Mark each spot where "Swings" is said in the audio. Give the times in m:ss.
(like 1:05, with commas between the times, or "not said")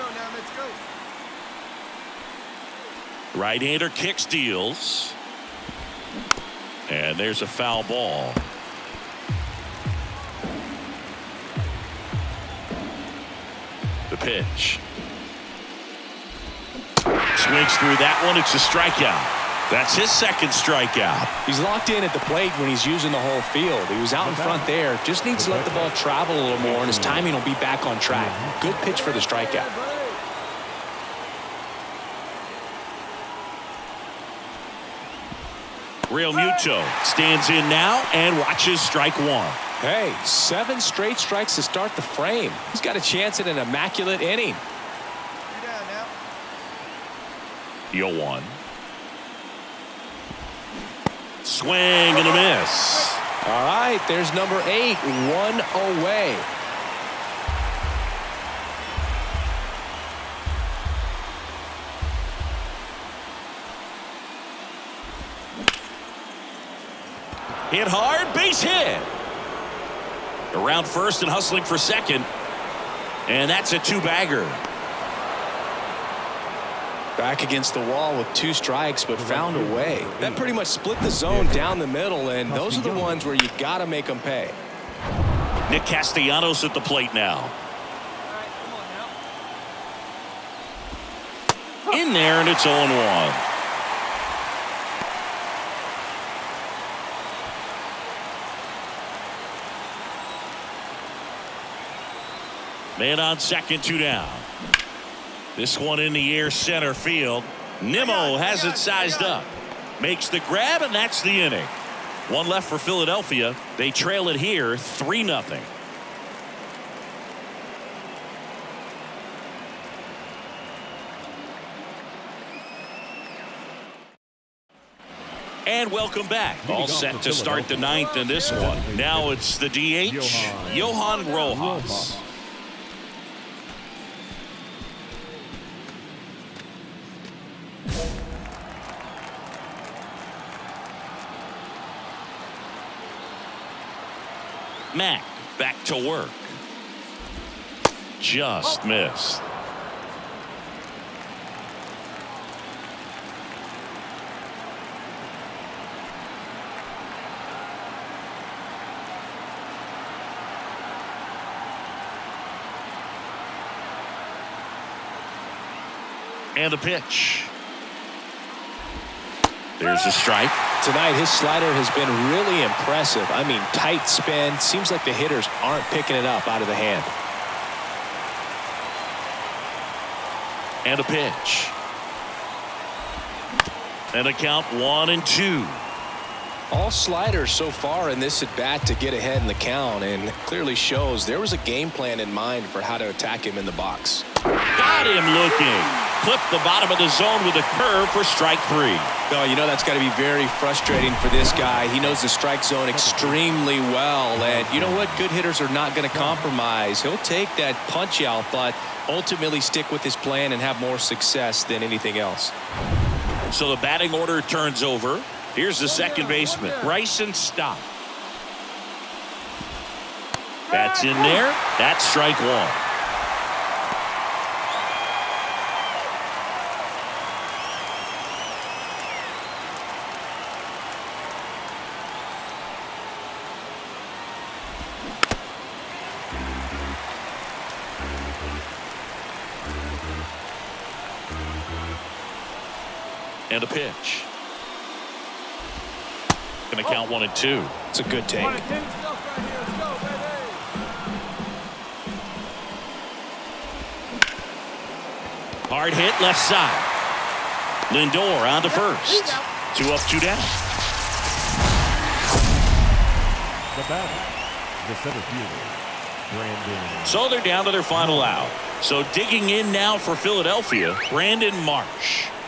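0:17, 0:51.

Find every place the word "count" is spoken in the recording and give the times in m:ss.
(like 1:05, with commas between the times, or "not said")
3:04, 3:09, 4:06.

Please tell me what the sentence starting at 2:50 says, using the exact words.
Tonight, his slider has been really impressive.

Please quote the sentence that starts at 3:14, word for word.
Got him looking clip the bottom of the zone with a curve for strike three.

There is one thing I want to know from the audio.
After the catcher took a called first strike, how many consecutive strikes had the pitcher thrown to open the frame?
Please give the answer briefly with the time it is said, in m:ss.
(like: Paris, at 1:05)
7, at 0:40.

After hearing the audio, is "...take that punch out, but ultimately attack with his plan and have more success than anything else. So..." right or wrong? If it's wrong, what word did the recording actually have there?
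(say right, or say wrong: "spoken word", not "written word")
wrong: "stick", not "attack".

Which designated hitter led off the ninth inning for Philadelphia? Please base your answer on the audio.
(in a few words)
Johan Rojas.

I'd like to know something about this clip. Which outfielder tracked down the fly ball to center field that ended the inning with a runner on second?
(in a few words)
Nimmo.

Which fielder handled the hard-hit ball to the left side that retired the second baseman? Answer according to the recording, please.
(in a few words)
Lindor.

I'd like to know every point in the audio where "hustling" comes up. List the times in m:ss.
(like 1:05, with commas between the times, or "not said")
1:11.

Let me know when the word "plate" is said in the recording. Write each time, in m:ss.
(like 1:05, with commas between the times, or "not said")
0:22, 1:26.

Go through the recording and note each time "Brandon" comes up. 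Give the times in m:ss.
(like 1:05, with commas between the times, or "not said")
4:26, 4:31.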